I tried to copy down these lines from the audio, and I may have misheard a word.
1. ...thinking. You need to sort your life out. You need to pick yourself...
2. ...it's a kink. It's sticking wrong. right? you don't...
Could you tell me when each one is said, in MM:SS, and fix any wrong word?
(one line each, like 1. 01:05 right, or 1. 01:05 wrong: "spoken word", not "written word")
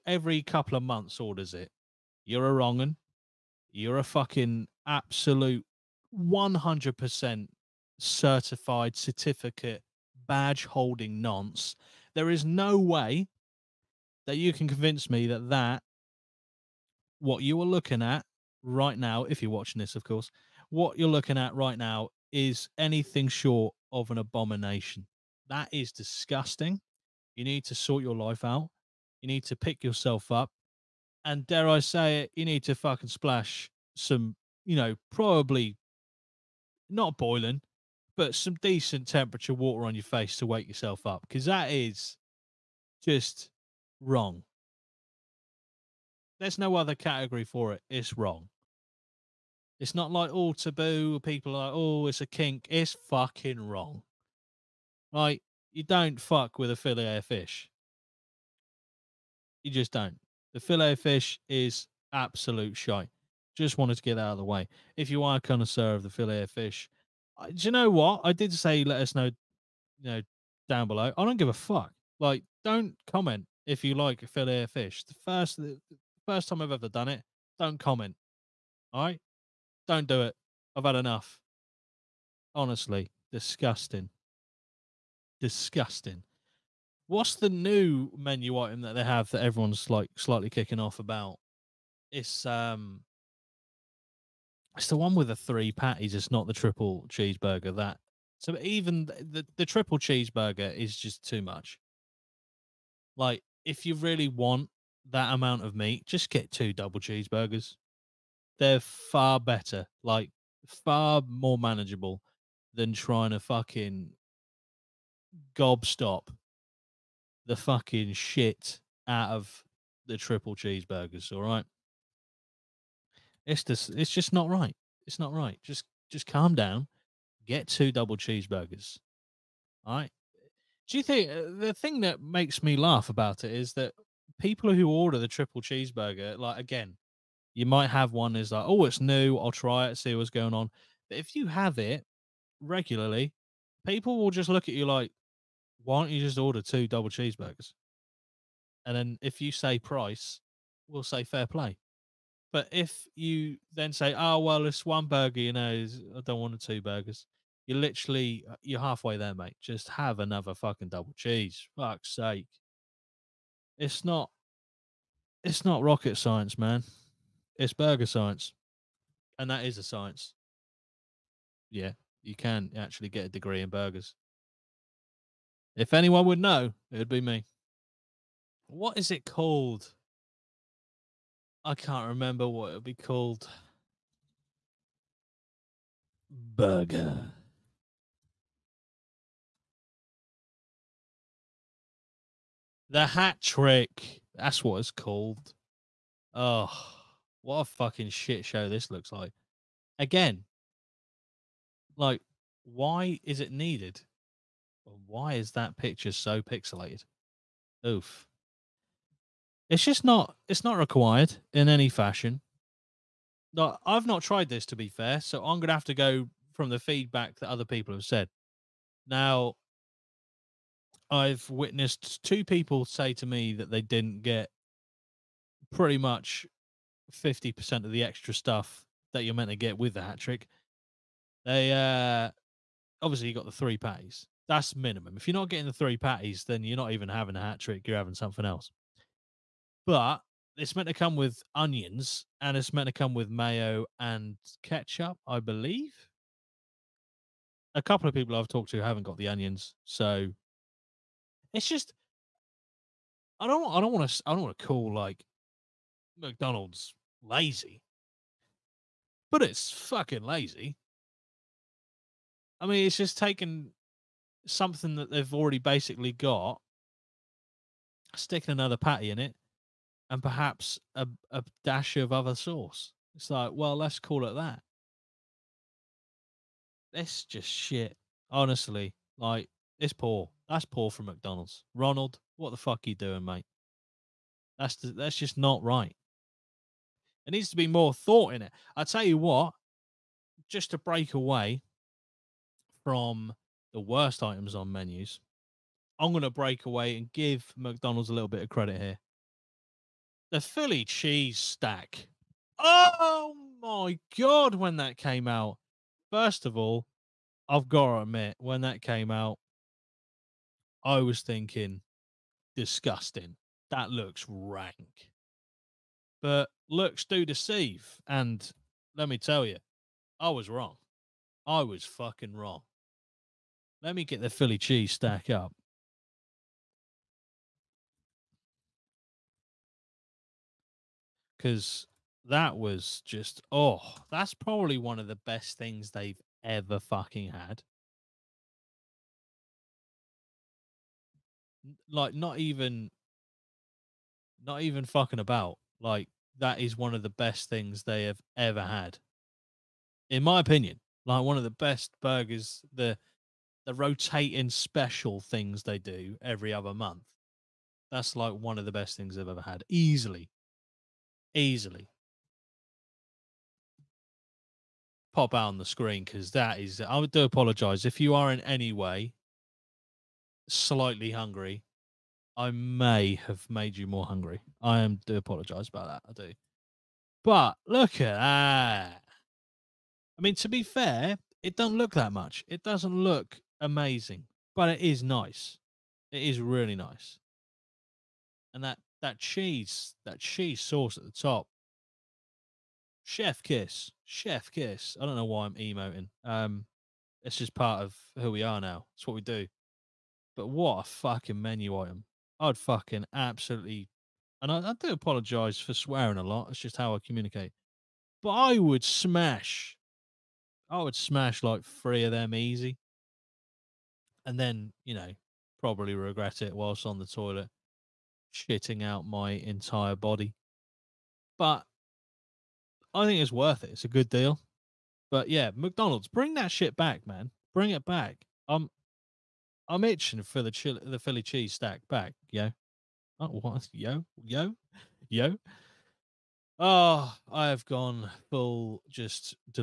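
1. 00:25 wrong: "disgusting", not "thinking"
2. 00:52 wrong: "fucking", not "sticking".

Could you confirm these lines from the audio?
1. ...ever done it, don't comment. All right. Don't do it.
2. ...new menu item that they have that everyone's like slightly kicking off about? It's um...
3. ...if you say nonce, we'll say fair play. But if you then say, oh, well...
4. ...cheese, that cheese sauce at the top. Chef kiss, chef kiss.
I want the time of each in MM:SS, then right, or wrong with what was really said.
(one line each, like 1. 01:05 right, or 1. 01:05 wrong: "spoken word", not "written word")
1. 01:16 right
2. 01:27 right
3. 02:29 wrong: "price", not "nonce"
4. 06:29 right.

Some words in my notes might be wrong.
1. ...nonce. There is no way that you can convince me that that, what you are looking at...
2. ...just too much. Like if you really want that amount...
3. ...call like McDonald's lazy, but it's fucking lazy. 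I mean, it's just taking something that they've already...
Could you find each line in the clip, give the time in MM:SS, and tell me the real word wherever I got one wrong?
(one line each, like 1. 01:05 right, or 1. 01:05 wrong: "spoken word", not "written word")
1. 00:11 right
2. 01:40 right
3. 04:14 right.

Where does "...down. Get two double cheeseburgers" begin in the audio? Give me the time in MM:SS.
02:06.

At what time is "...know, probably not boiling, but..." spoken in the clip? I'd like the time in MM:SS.
00:34.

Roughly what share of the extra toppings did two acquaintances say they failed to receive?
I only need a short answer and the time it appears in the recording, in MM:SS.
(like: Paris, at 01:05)
50%, at 03:47.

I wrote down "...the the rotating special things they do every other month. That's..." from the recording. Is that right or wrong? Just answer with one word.
right.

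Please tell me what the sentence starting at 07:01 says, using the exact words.
But I think it's worth it.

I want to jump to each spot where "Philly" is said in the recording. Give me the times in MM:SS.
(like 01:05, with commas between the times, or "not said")
05:00, 05:24, 07:10.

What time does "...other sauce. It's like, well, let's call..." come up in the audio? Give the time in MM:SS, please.
04:32.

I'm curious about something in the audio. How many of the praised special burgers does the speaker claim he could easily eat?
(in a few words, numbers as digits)
3.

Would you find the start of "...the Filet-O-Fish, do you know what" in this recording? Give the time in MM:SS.
01:06.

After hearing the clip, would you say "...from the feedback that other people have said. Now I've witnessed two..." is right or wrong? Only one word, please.
right.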